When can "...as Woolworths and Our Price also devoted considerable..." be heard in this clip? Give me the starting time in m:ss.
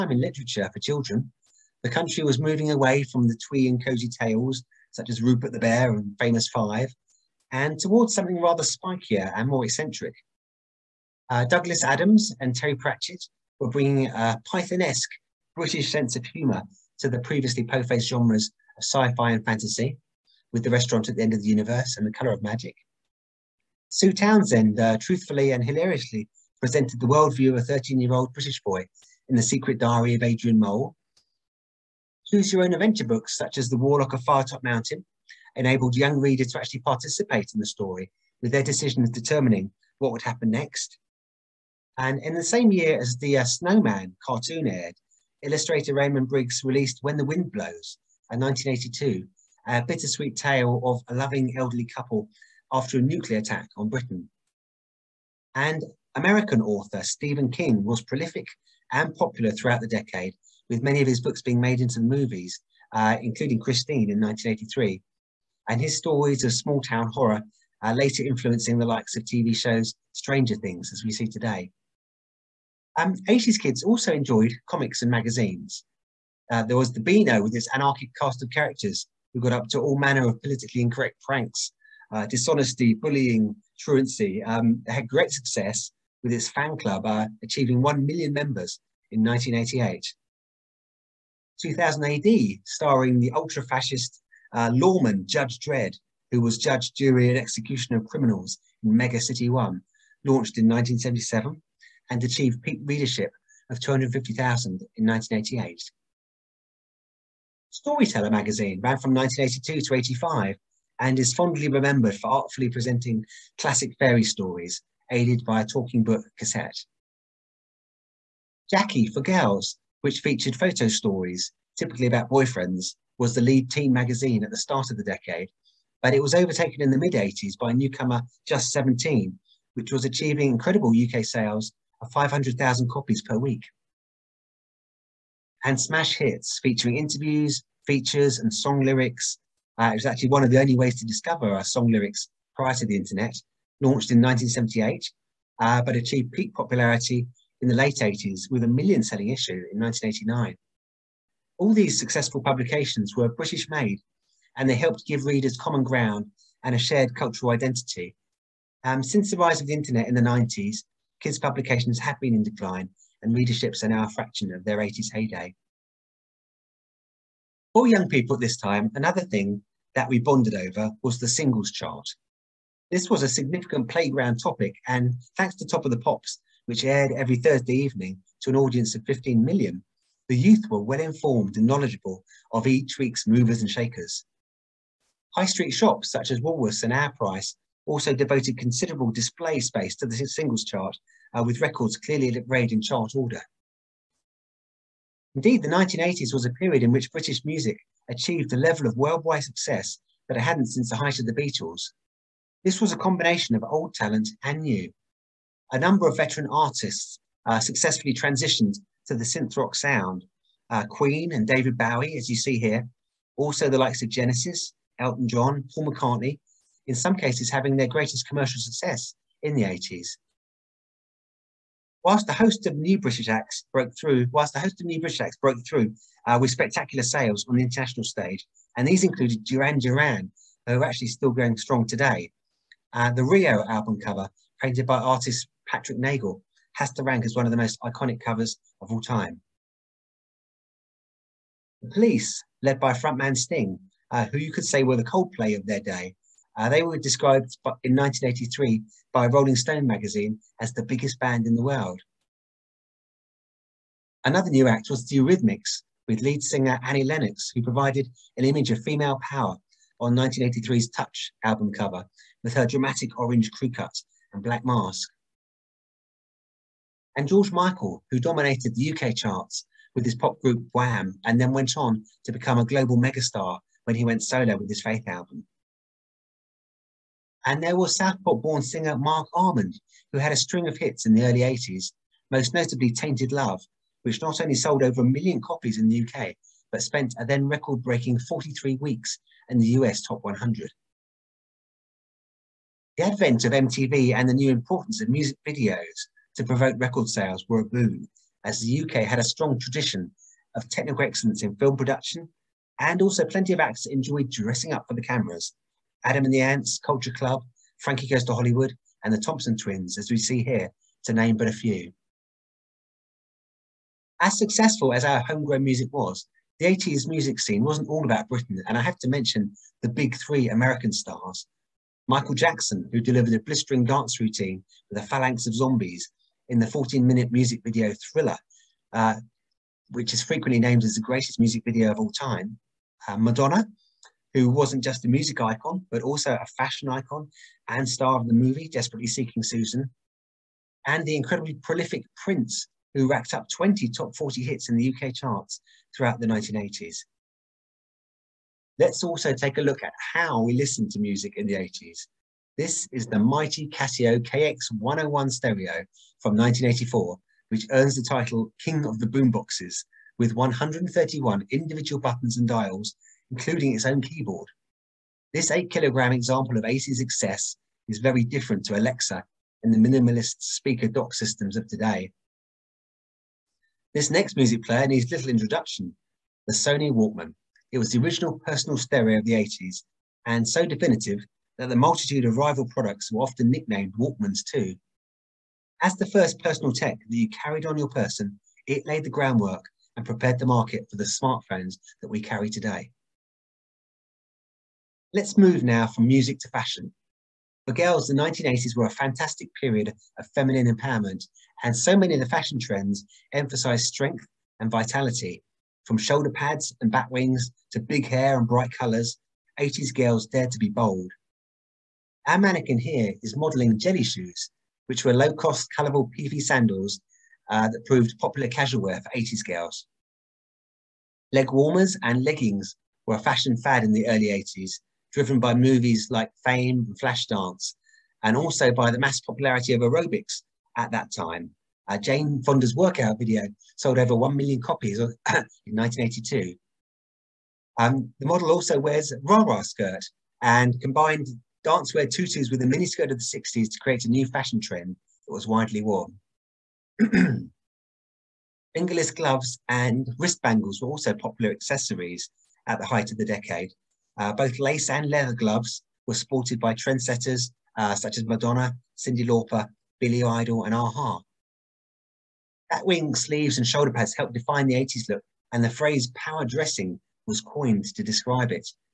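3:06.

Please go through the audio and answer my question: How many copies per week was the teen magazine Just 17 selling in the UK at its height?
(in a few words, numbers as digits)
500,000.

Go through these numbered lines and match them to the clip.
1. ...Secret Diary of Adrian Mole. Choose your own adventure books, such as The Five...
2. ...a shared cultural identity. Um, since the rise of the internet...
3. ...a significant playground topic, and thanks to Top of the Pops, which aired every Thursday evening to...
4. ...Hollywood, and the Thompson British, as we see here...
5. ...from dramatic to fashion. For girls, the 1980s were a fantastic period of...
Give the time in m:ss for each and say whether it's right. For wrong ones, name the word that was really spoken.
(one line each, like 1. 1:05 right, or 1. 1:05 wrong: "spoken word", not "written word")
1. 0:29 wrong: "Warlock", not "Five"
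2. 2:36 right
3. 2:53 right
4. 5:08 wrong: "Twins", not "British"
5. 6:35 wrong: "music", not "dramatic".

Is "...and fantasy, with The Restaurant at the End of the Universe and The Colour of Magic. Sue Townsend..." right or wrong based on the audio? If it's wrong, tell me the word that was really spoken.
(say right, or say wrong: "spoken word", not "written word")
right.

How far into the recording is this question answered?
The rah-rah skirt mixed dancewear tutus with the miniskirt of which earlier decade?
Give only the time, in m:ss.
7:23.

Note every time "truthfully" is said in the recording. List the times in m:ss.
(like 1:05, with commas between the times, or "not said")
0:24.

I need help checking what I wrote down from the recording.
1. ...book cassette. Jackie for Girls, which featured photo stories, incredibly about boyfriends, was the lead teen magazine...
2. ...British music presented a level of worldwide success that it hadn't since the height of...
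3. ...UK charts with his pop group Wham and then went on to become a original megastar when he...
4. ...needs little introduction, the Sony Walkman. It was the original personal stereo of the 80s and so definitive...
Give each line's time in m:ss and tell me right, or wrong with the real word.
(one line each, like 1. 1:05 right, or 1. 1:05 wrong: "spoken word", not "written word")
1. 1:56 wrong: "typically", not "incredibly"
2. 3:17 wrong: "achieved", not "presented"
3. 4:28 wrong: "global", not "original"
4. 6:14 right.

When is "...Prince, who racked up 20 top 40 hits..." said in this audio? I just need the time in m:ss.
5:42.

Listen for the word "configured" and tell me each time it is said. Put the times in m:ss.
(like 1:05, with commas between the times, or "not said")
not said.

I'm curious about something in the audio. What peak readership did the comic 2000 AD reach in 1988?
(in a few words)
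250,000.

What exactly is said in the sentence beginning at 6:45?
From shoulder pads and back wings to big hair and bright colors, 80s girls dared to be bold.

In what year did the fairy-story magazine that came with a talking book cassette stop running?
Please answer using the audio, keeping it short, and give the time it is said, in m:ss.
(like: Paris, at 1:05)
1985, at 1:49.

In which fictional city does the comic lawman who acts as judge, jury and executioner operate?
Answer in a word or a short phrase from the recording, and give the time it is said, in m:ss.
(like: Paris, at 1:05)
Mega City 1, at 1:38.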